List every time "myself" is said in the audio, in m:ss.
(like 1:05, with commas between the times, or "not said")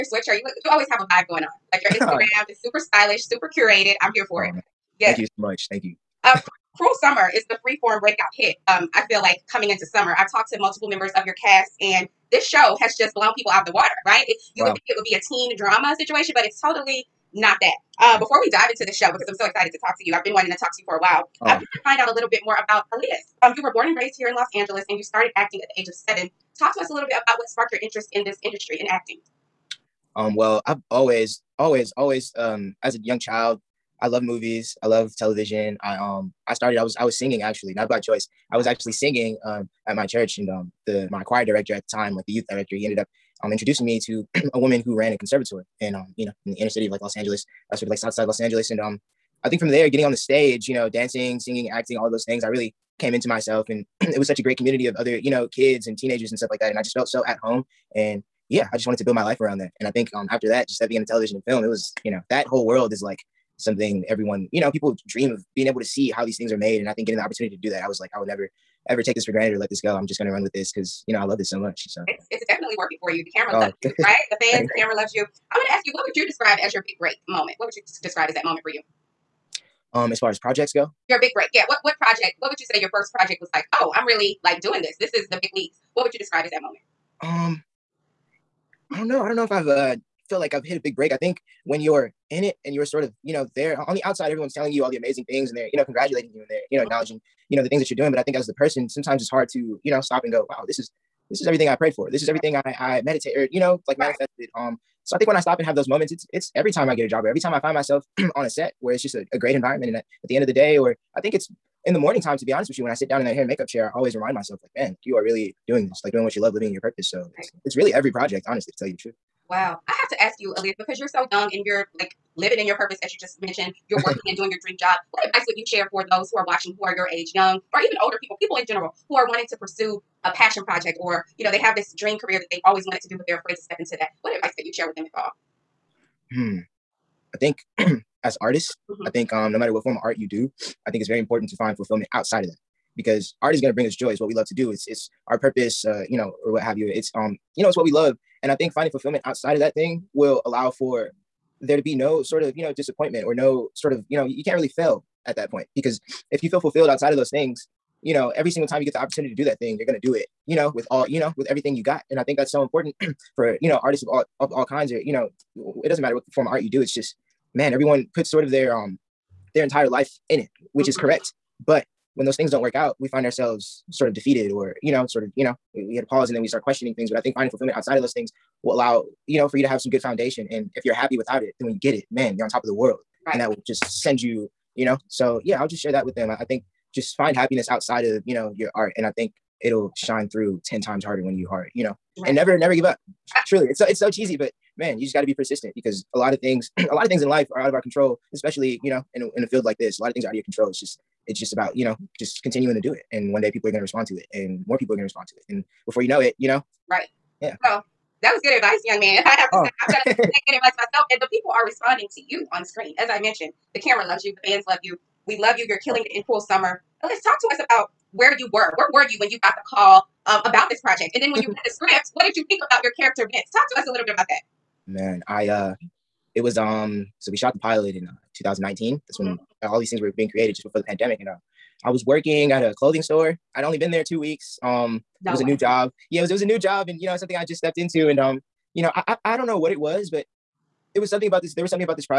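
0:53, 1:47, 1:54, 3:30.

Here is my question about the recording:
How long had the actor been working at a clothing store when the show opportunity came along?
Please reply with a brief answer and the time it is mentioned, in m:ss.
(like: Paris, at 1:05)
2 weeks, at 3:54.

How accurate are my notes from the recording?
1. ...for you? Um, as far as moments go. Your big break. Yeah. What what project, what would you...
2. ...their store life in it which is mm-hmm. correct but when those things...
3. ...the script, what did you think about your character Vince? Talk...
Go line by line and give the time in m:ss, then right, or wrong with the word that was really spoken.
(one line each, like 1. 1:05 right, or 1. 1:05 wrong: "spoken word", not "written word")
1. 1:18 wrong: "projects", not "moments"
2. 2:49 wrong: "entire", not "store"
3. 3:41 right.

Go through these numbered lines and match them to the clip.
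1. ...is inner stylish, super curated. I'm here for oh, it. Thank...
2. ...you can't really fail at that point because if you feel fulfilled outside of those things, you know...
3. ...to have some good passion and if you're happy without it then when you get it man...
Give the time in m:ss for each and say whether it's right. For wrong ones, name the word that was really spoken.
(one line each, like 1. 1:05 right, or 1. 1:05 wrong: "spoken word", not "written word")
1. 0:02 wrong: "super", not "inner"
2. 2:34 right
3. 2:59 wrong: "foundation", not "passion".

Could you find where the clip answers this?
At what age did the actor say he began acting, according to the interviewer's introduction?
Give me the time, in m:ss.
0:25.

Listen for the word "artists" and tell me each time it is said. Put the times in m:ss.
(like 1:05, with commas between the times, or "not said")
2:18, 2:43.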